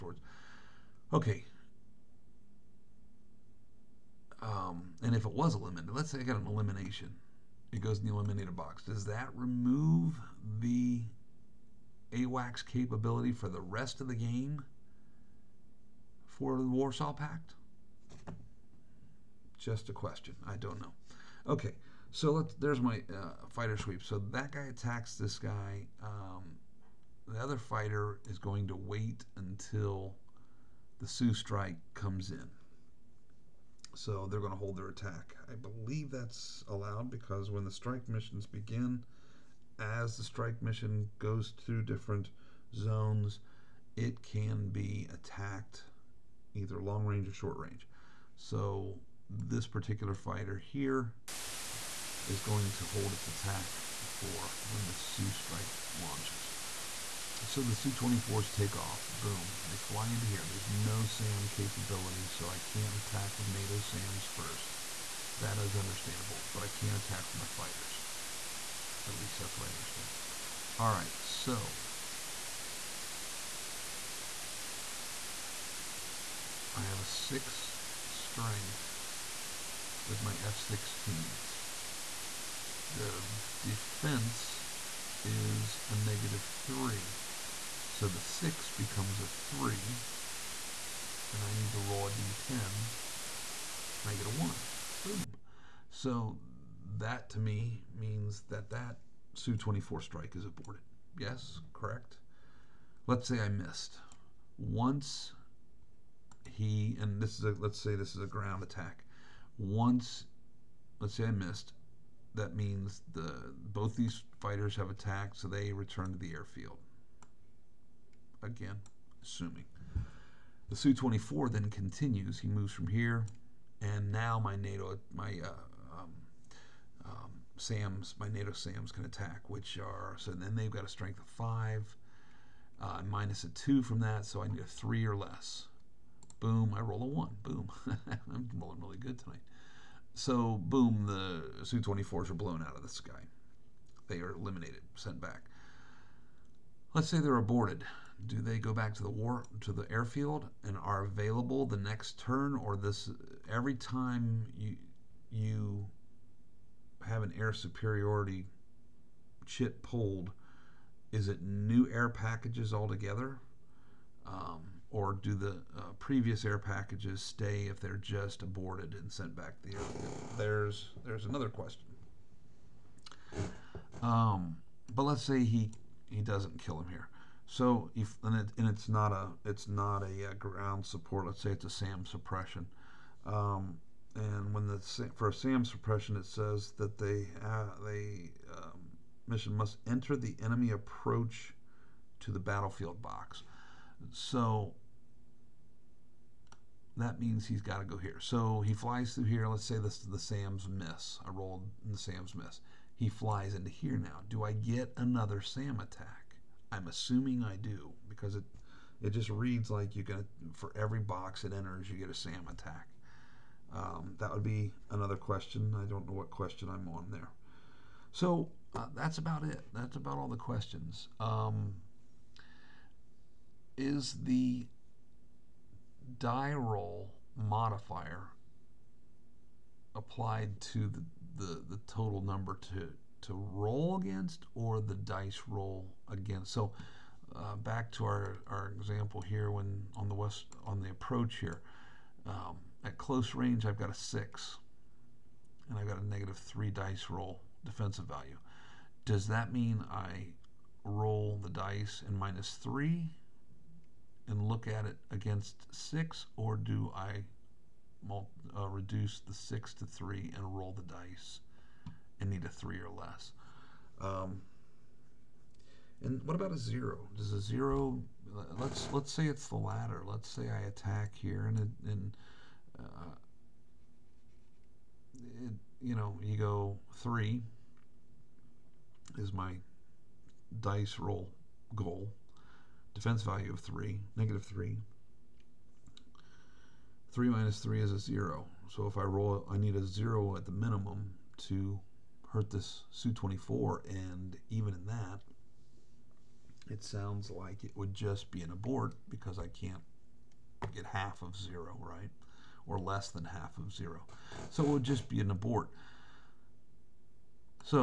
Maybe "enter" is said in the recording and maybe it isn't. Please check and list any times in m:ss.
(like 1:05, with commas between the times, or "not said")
3:09, 3:31.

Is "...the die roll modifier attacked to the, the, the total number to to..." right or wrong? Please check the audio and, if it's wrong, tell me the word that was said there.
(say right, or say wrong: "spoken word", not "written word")
wrong: "applied", not "attacked".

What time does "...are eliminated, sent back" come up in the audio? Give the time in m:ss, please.
2:24.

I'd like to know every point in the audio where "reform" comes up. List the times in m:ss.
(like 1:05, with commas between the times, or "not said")
not said.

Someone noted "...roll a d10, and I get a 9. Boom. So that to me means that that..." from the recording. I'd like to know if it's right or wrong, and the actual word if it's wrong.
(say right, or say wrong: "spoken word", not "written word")
wrong: "1", not "9".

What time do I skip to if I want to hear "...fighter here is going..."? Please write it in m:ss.
0:50.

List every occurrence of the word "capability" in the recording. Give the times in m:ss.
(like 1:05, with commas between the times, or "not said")
0:12, 1:01.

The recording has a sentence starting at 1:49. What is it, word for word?
Once, let's say I missed, that means the both these fighters have attacked, so they return to the airfield again, assuming.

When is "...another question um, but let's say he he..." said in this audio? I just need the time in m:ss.
2:51.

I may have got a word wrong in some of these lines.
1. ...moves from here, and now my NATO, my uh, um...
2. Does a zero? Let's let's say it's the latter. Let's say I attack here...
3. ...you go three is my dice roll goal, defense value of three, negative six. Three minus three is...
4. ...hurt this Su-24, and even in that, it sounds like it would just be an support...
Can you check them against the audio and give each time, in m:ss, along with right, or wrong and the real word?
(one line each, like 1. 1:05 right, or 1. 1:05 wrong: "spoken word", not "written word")
1. 2:02 right
2. 4:27 right
3. 4:36 wrong: "three", not "six"
4. 4:52 wrong: "abort", not "support".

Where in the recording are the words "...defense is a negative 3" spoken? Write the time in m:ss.
1:23.